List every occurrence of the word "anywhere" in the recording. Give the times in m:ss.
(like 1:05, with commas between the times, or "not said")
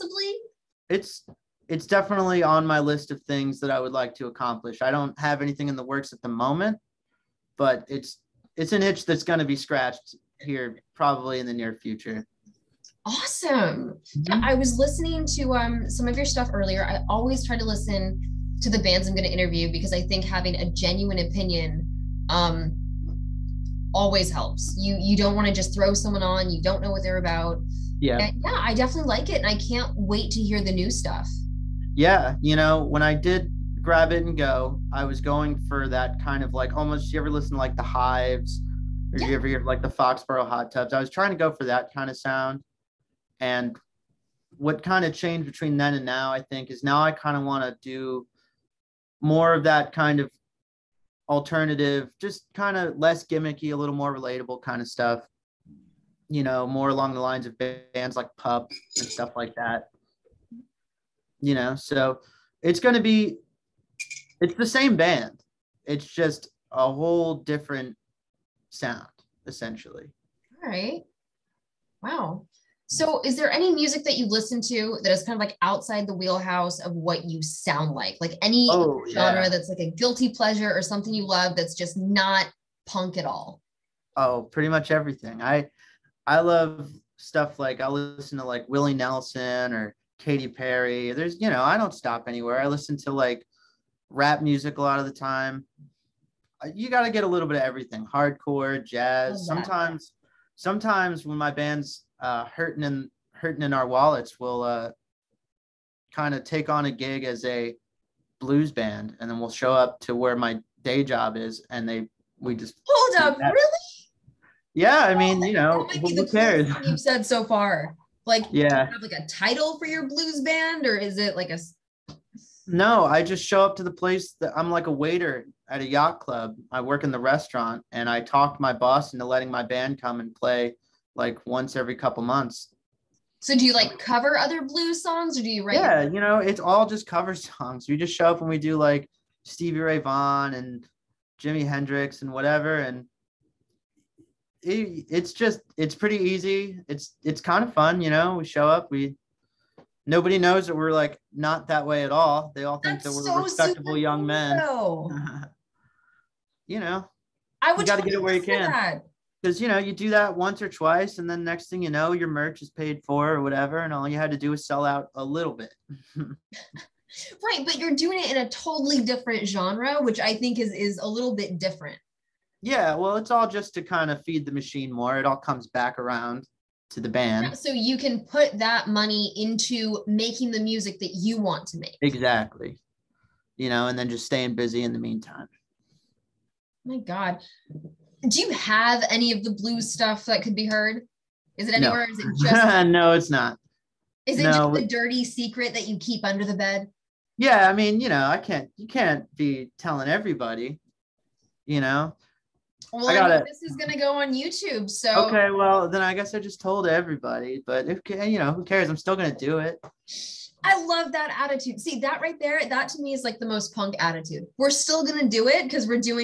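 1:32, 3:11.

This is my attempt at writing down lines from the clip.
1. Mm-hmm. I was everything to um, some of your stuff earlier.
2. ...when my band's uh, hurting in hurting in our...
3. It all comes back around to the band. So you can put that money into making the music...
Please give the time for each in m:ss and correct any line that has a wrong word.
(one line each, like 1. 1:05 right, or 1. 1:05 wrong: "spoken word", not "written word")
1. 0:14 wrong: "listening", not "everything"
2. 1:41 right
3. 2:55 right.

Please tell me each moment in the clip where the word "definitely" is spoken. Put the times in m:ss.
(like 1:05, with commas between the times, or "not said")
0:01, 0:28.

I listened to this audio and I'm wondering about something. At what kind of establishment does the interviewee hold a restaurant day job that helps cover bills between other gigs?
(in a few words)
Yacht club.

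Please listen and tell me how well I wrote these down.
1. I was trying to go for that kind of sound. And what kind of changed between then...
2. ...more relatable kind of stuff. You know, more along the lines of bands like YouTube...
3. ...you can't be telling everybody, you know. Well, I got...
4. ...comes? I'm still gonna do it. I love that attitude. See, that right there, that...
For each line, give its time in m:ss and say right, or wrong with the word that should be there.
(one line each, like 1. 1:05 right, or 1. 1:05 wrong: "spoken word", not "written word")
1. 0:40 right
2. 0:53 wrong: "Pup", not "YouTube"
3. 3:18 right
4. 3:28 wrong: "cares", not "comes".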